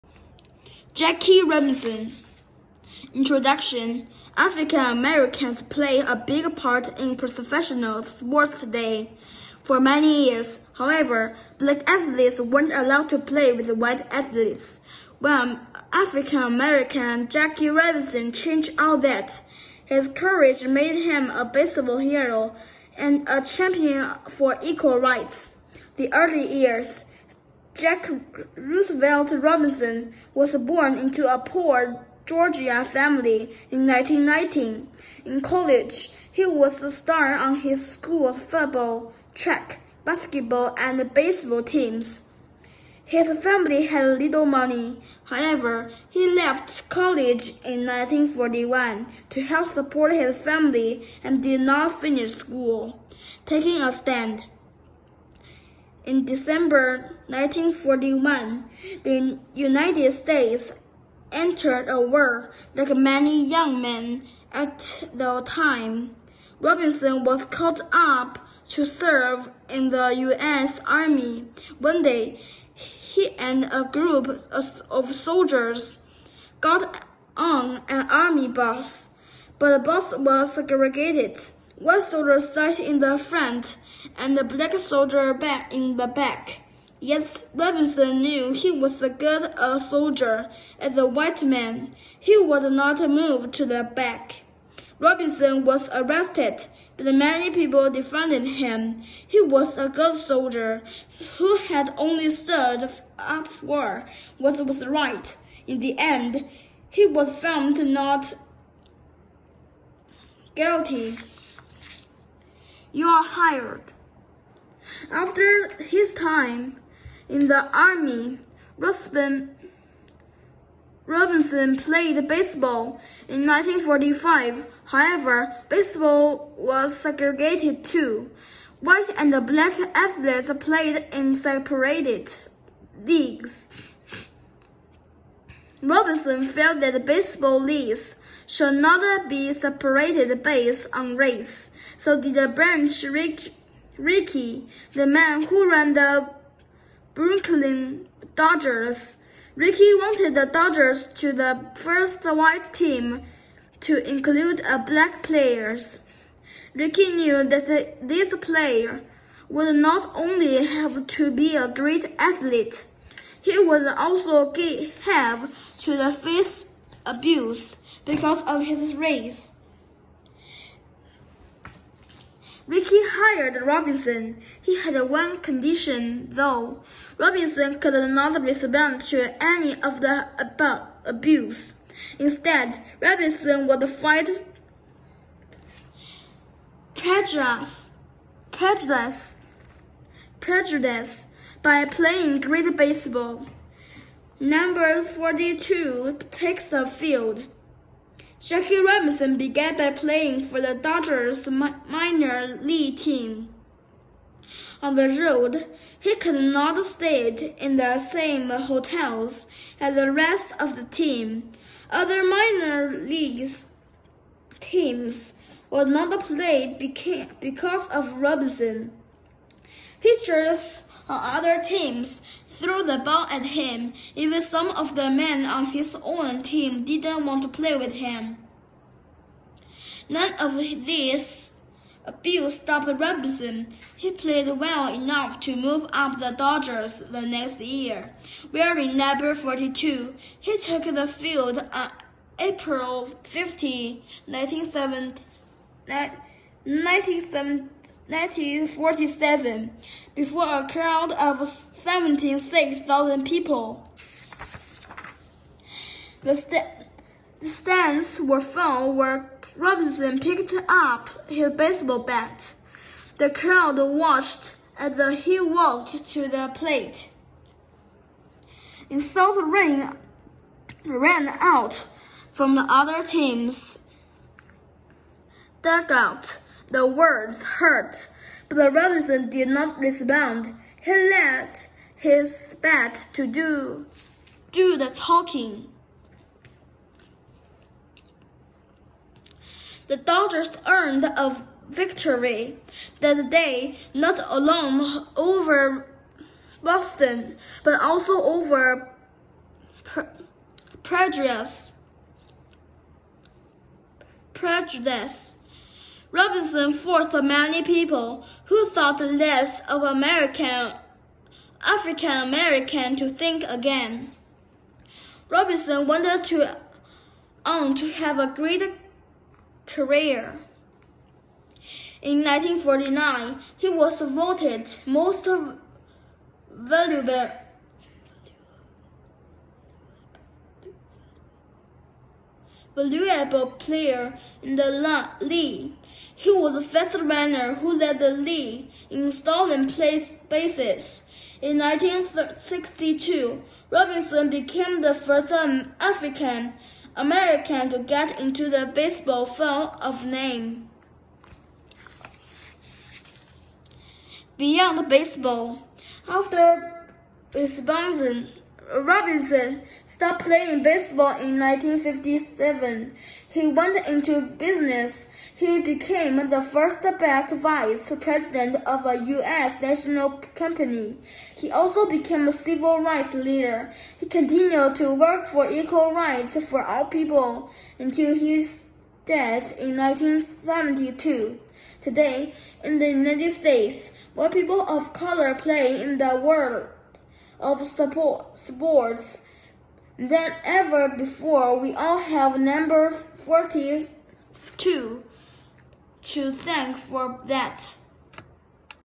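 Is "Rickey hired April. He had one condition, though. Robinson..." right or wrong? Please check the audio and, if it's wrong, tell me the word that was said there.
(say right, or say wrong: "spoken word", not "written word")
wrong: "Robinson", not "April".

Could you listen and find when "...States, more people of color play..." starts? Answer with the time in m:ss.
6:23.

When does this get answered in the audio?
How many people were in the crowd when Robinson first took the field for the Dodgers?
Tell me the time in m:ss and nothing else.
4:11.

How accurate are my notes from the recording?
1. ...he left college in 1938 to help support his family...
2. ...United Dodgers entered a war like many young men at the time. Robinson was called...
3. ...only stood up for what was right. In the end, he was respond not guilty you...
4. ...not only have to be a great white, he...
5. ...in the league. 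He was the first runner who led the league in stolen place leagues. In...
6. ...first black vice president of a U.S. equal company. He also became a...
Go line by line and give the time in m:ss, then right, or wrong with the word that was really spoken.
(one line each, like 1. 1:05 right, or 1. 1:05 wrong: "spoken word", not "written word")
1. 0:46 wrong: "1941", not "1938"
2. 0:59 wrong: "States", not "Dodgers"
3. 1:41 wrong: "found", not "respond"
4. 2:39 wrong: "athlete", not "white"
5. 5:34 wrong: "bases", not "leagues"
6. 6:06 wrong: "national", not "equal".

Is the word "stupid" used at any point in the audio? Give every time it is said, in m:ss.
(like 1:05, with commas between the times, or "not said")
not said.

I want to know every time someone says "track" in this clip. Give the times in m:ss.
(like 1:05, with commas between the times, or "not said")
0:39.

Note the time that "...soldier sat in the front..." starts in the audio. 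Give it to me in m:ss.
1:22.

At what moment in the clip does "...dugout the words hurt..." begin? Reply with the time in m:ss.
4:35.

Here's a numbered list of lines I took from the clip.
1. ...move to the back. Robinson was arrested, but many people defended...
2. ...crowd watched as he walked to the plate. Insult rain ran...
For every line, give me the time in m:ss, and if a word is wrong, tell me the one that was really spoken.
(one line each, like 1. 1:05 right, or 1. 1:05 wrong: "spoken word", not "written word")
1. 1:33 right
2. 4:23 right.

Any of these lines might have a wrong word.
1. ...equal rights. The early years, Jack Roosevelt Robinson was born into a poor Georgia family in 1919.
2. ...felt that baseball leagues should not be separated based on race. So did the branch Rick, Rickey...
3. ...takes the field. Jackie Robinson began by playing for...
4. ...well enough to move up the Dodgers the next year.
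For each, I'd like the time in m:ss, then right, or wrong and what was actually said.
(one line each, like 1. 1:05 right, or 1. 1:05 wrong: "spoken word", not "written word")
1. 0:24 right
2. 2:16 right
3. 3:16 right
4. 3:54 right.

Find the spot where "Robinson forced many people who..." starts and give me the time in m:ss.
5:06.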